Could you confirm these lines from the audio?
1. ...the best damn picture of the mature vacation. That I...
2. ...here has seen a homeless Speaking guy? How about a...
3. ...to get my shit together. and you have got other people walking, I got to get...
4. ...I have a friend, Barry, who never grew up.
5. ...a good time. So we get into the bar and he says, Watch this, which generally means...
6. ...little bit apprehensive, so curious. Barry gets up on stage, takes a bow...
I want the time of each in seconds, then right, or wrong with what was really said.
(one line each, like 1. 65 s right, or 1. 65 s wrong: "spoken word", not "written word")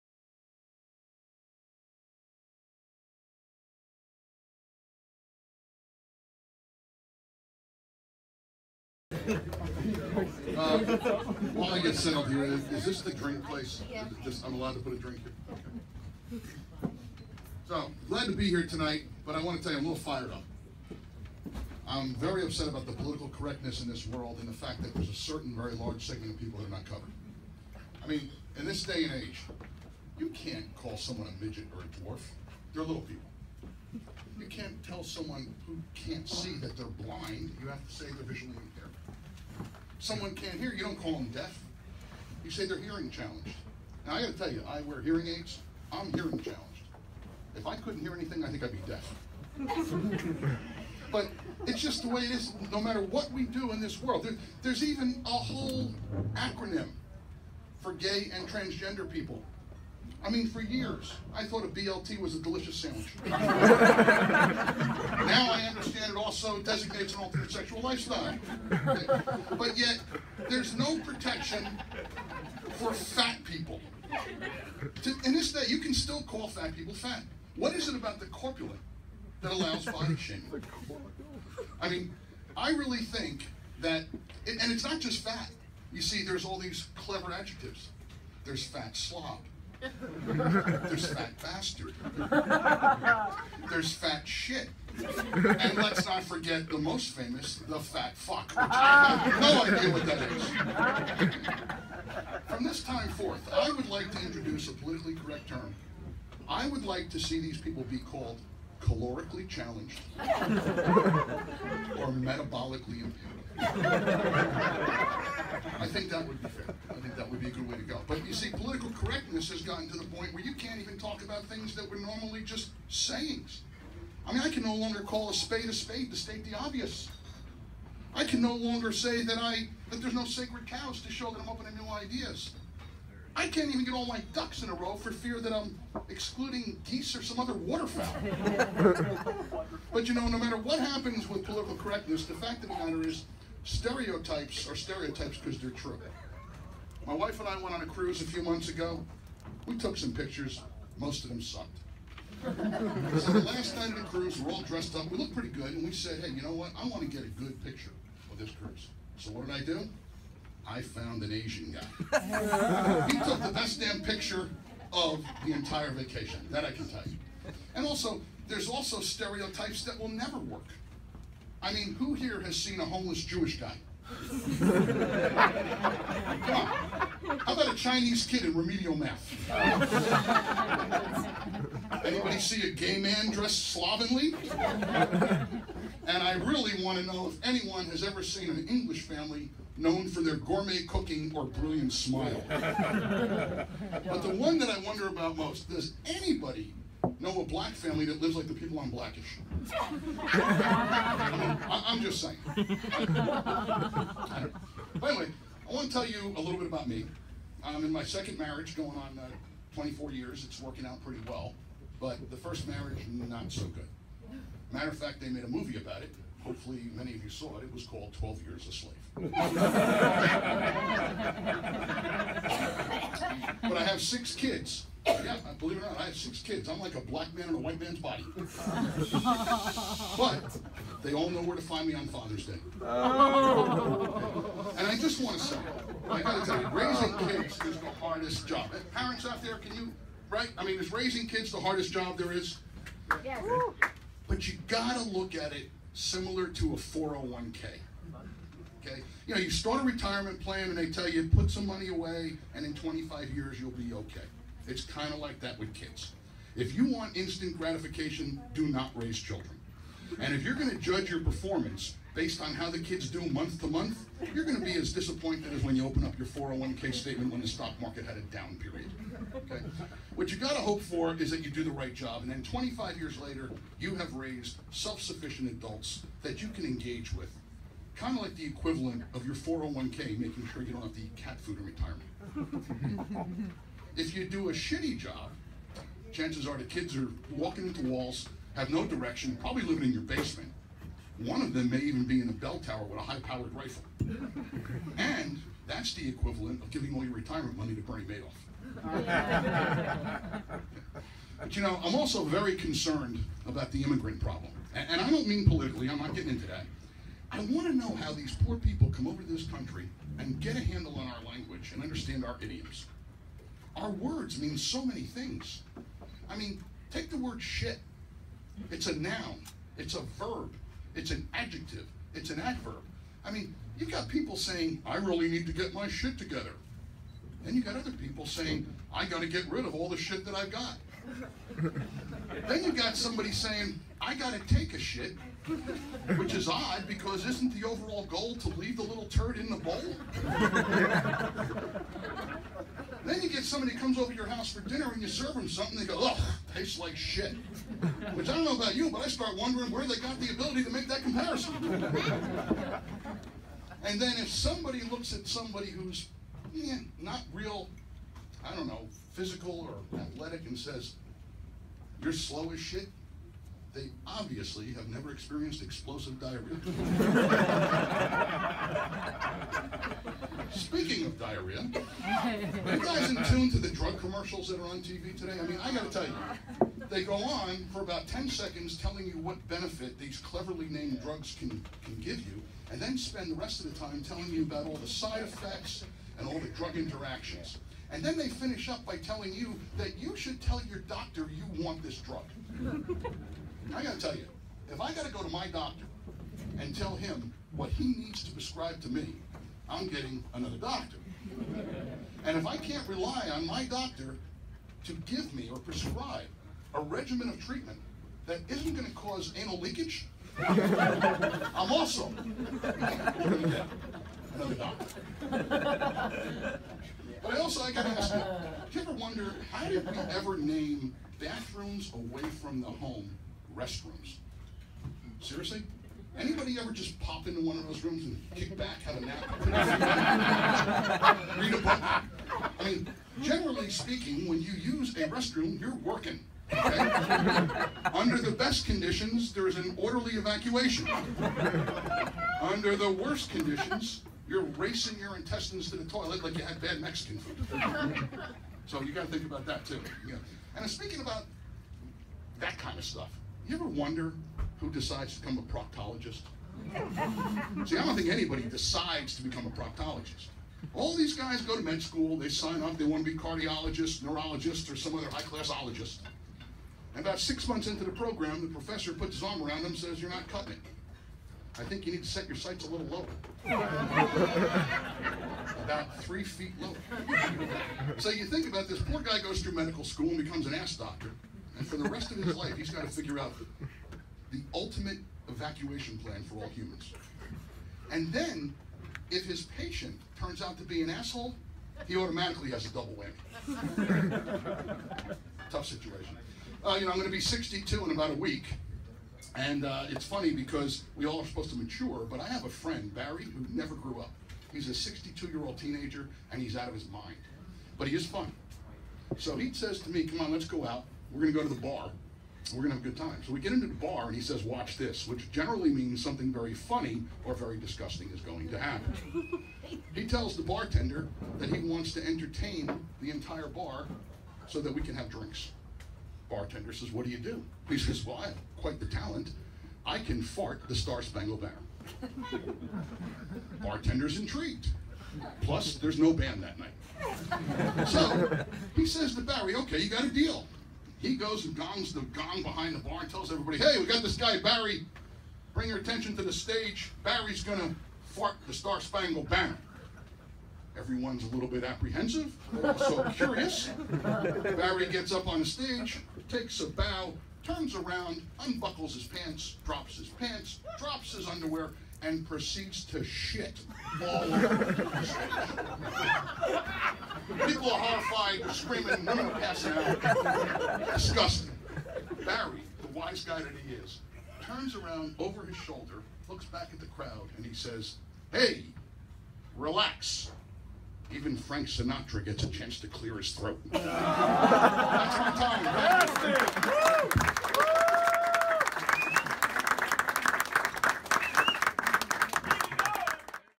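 1. 163 s wrong: "entire", not "mature"
2. 172 s wrong: "Jewish", not "Speaking"
3. 325 s wrong: "saying", not "walking"
4. 502 s right
5. 512 s right
6. 551 s right.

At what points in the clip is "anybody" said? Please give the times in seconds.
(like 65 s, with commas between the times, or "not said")
182 s, 196 s, 426 s, 458 s.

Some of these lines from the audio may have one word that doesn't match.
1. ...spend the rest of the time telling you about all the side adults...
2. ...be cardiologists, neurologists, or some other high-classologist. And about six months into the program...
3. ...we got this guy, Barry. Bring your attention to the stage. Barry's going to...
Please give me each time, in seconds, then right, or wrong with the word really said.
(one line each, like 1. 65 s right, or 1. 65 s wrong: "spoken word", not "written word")
1. 382 s wrong: "effects", not "adults"
2. 463 s right
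3. 543 s right.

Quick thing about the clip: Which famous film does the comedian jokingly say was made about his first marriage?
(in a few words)
12 Years a Slave.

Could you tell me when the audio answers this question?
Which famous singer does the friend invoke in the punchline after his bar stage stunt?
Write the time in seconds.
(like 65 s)
581 s.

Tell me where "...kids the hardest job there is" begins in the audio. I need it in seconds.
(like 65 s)
241 s.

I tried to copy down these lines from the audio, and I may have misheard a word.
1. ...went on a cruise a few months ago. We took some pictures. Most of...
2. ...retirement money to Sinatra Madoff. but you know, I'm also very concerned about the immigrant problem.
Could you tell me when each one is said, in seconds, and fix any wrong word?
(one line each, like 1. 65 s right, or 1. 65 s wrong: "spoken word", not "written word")
1. 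147 s right
2. 297 s wrong: "Bernie", not "Sinatra".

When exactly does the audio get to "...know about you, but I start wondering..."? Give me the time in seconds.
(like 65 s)
348 s.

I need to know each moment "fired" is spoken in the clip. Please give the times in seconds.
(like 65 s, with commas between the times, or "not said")
20 s.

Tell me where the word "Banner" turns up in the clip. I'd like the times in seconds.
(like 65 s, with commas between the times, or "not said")
531 s, 549 s.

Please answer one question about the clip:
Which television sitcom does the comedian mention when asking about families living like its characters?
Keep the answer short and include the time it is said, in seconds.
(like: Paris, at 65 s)
Blackish, at 198 s.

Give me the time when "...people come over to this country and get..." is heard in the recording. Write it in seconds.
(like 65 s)
308 s.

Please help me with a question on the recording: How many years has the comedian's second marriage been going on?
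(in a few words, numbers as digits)
24.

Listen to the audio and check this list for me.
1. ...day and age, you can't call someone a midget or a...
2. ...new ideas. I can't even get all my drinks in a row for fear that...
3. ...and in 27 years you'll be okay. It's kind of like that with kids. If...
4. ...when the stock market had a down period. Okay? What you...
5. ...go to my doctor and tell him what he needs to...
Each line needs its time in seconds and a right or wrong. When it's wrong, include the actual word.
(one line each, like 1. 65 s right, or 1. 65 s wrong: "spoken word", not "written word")
1. 28 s right
2. 131 s wrong: "ducks", not "drinks"
3. 252 s wrong: "25", not "27"
4. 267 s right
5. 395 s right.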